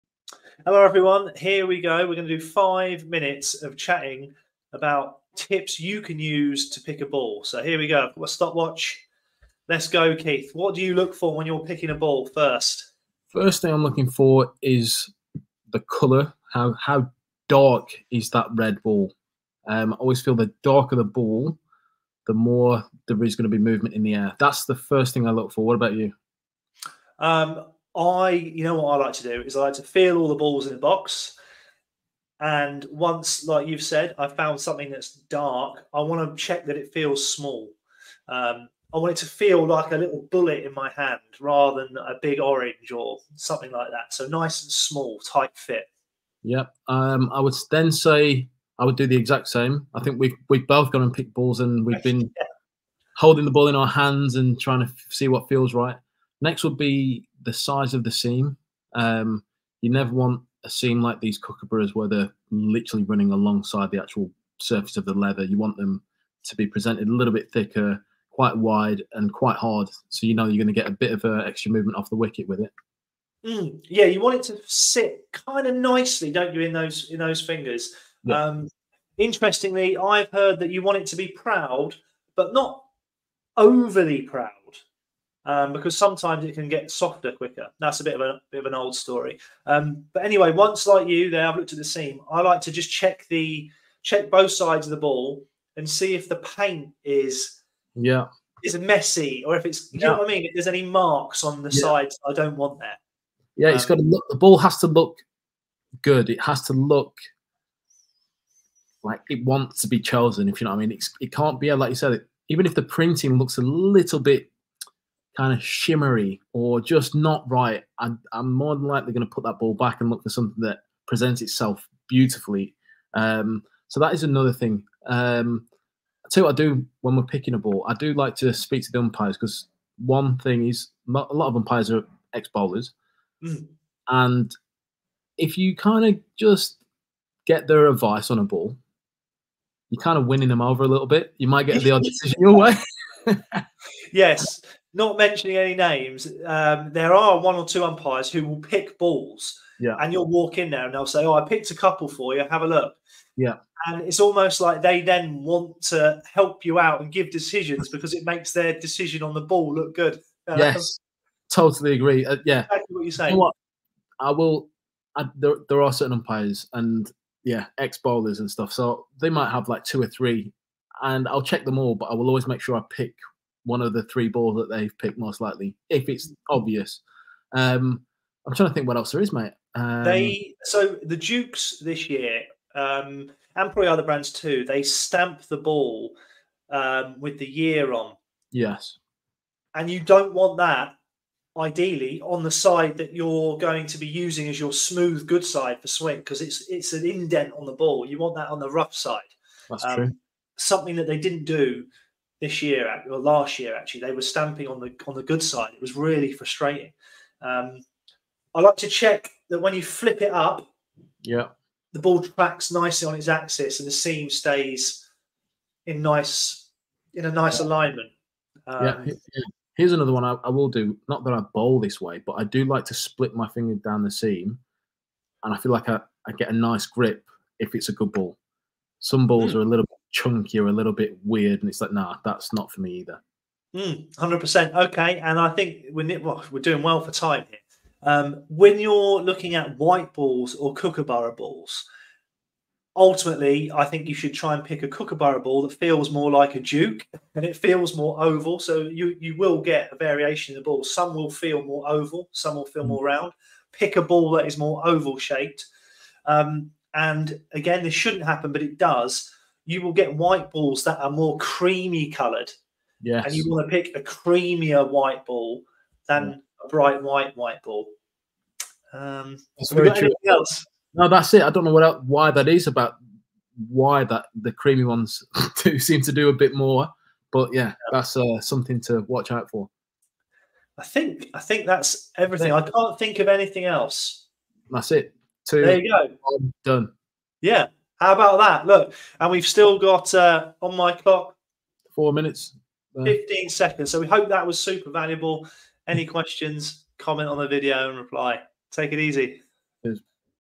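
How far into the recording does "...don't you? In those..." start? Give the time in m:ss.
1:16.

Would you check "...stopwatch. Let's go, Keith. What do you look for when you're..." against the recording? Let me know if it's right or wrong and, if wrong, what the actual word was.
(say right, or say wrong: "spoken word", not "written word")
right.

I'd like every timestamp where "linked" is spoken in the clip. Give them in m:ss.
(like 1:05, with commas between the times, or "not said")
not said.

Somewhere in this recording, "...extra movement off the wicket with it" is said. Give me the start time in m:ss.
1:11.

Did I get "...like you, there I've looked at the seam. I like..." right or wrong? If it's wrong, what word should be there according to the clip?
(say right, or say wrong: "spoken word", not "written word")
right.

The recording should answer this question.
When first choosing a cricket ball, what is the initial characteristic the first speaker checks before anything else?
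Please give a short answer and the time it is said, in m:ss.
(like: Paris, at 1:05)
colour, at 0:15.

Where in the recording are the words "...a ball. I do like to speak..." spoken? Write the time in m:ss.
2:07.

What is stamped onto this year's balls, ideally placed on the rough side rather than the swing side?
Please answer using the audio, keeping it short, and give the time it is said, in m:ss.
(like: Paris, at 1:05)
the year, at 3:07.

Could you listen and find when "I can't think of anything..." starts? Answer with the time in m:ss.
4:42.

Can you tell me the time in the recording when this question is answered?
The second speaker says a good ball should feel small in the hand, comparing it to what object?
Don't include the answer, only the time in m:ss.
0:39.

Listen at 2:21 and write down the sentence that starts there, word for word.
You might get the odd decision your way.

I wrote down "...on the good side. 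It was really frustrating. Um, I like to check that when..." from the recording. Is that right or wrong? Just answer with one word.
right.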